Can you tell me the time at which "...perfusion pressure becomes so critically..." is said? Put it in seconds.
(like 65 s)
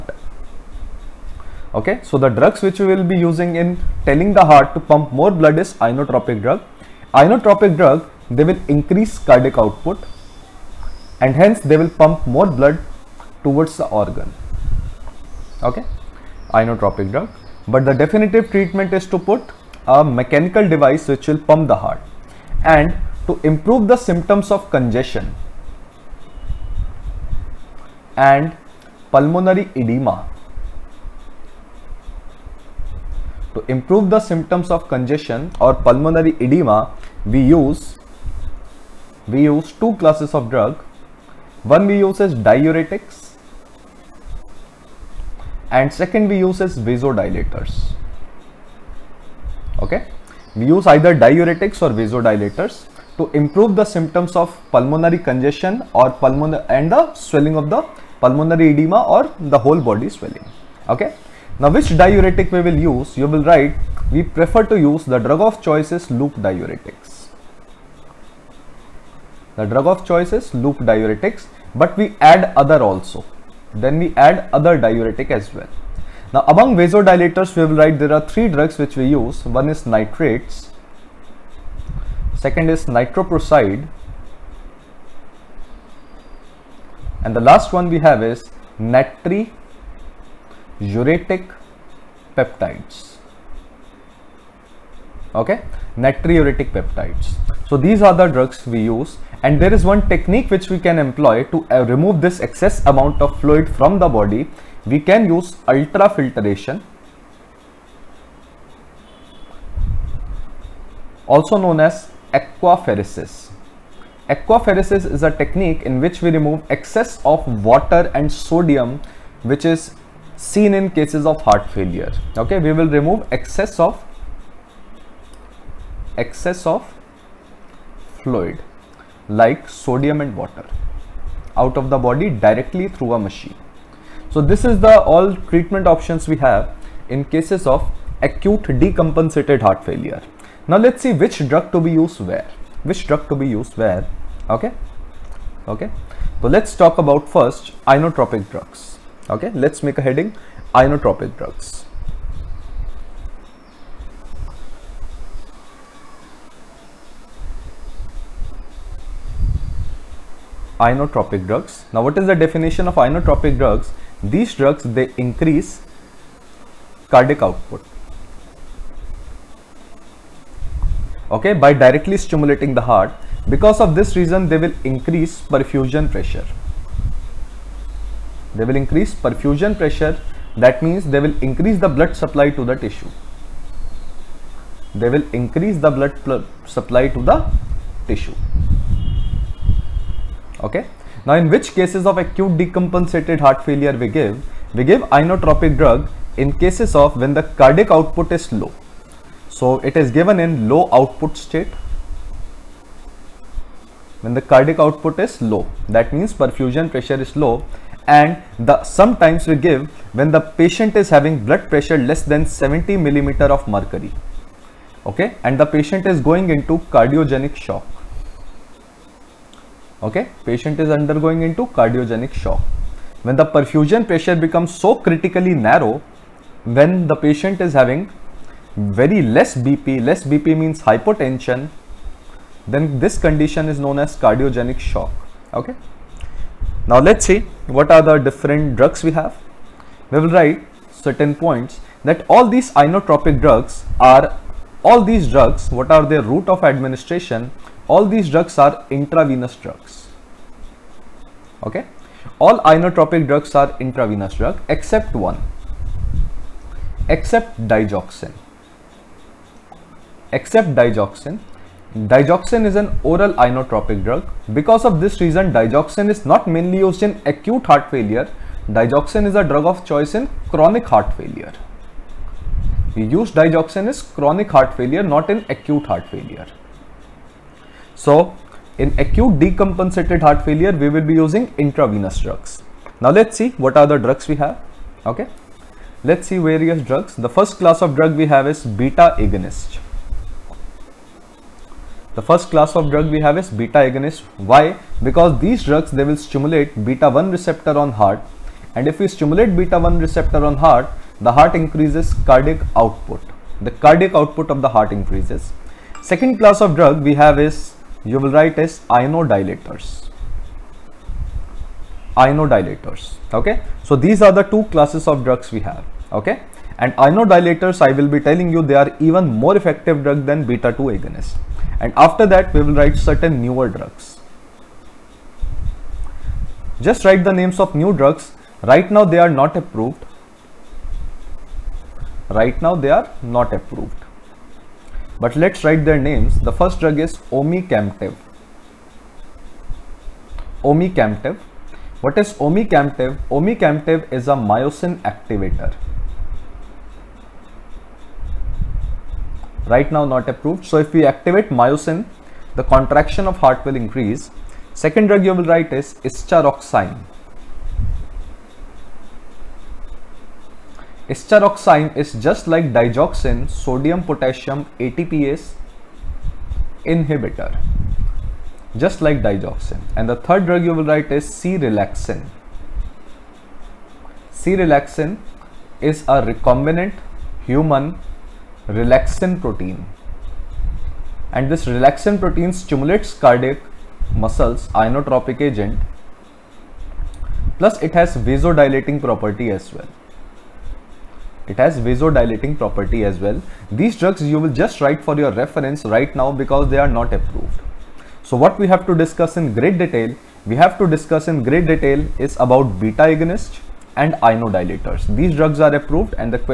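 223 s.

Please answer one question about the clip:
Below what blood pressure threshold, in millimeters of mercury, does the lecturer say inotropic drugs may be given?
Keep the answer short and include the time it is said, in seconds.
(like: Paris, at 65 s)
70, at 212 s.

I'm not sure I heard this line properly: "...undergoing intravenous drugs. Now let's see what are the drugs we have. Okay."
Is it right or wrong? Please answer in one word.
wrong.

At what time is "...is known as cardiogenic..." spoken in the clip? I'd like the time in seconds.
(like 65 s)
233 s.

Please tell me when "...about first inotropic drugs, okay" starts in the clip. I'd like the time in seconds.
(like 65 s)
146 s.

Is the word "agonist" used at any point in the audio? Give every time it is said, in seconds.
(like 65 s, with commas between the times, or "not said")
289 s, 293 s, 320 s, 403 s.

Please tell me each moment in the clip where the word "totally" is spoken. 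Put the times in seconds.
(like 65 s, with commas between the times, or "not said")
not said.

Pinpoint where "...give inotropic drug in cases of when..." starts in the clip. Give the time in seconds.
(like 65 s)
194 s.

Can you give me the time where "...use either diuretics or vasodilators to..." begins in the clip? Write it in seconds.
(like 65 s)
50 s.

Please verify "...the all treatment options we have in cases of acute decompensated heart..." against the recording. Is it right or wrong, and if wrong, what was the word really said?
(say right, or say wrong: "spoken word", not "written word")
right.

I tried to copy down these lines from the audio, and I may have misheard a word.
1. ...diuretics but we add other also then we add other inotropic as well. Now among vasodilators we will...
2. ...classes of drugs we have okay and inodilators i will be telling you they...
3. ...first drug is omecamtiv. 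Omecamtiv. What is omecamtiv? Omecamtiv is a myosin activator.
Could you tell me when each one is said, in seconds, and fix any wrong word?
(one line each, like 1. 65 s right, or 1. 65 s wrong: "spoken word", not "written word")
1. 70 s wrong: "diuretic", not "inotropic"
2. 314 s right
3. 336 s right.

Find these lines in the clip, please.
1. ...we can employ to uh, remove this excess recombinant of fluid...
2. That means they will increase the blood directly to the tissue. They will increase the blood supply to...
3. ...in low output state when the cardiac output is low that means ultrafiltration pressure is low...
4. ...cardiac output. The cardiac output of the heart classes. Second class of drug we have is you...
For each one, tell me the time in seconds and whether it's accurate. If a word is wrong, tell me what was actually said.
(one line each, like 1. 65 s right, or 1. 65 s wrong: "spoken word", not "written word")
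1. 100 s wrong: "amount", not "recombinant"
2. 180 s wrong: "supply", not "directly"
3. 200 s wrong: "perfusion", not "ultrafiltration"
4. 302 s wrong: "increases", not "classes".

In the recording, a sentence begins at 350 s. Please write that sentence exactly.
So if we activate myosin, the contraction of heart will increase.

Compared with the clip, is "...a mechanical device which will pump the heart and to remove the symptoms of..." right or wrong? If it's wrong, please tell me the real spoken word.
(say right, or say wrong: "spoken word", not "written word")
wrong: "improve", not "remove".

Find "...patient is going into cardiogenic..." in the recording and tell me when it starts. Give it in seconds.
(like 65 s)
215 s.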